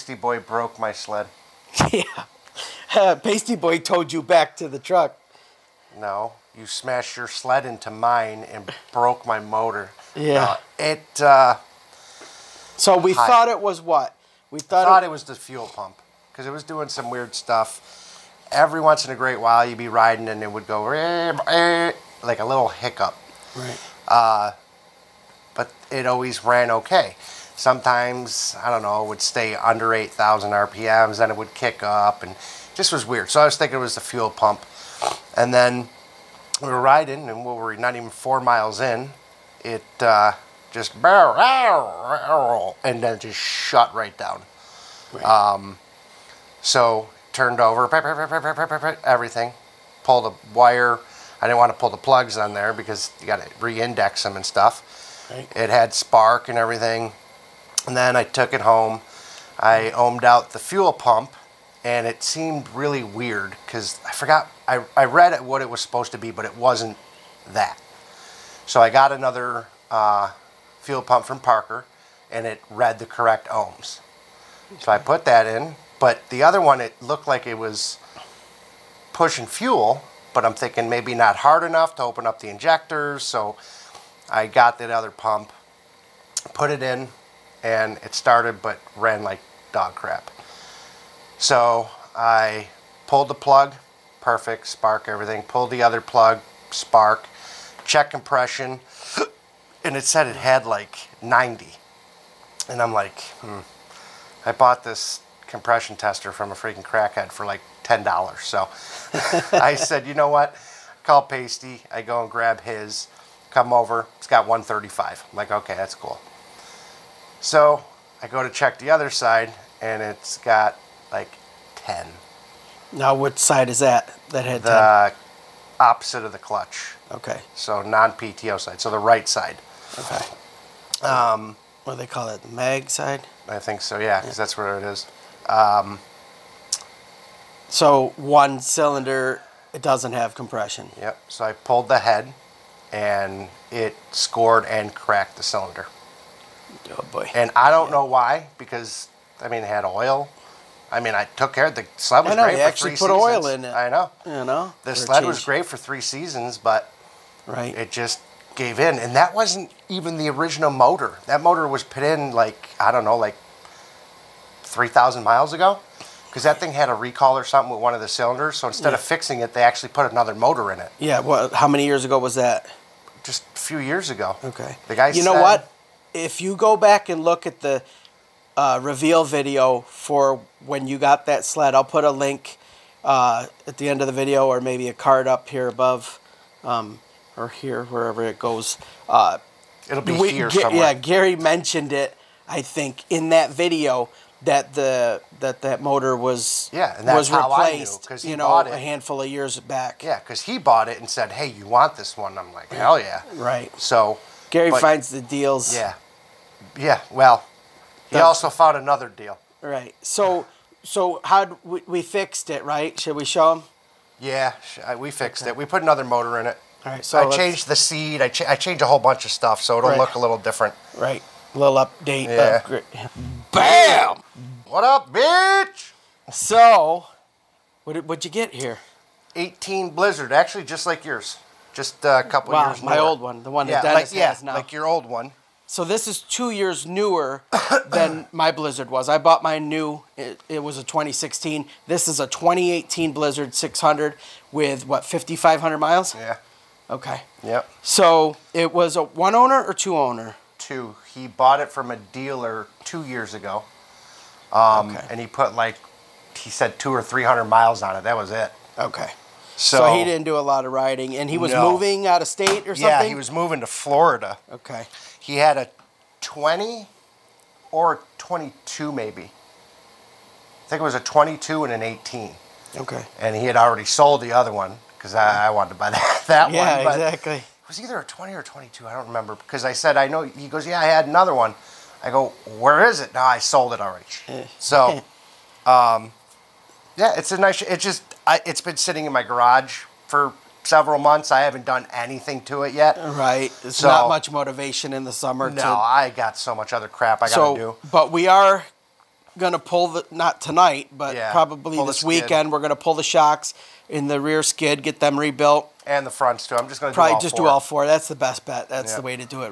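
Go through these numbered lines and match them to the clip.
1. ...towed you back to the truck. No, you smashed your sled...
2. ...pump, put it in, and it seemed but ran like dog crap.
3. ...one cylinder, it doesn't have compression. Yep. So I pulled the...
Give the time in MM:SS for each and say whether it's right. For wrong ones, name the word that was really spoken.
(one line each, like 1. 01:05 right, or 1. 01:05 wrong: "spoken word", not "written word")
1. 00:03 right
2. 01:25 wrong: "started", not "seemed"
3. 02:18 right.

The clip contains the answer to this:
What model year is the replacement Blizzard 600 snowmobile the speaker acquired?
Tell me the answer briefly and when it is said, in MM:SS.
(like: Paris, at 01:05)
2018, at 04:02.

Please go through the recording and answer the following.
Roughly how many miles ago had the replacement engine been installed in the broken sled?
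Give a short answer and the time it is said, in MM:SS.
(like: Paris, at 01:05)
3,000, at 02:44.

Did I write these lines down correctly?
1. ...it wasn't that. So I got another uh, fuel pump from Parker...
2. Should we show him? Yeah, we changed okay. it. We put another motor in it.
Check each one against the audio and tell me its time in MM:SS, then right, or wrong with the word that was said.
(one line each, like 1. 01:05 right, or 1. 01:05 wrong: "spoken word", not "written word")
1. 01:06 right
2. 03:32 wrong: "fixed", not "changed".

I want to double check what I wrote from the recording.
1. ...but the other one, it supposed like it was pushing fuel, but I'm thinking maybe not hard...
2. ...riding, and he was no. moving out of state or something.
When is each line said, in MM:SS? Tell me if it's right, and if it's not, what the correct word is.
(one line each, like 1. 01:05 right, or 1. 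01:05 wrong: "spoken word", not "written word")
1. 01:15 wrong: "looked", not "supposed"
2. 04:20 right.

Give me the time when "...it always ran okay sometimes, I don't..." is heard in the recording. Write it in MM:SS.
00:25.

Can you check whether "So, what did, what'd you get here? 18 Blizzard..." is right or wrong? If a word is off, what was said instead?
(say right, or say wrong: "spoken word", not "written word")
right.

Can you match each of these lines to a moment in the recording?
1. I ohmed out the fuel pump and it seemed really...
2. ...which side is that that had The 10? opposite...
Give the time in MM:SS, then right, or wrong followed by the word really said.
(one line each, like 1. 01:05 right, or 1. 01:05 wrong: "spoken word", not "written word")
1. 00:59 right
2. 02:03 right.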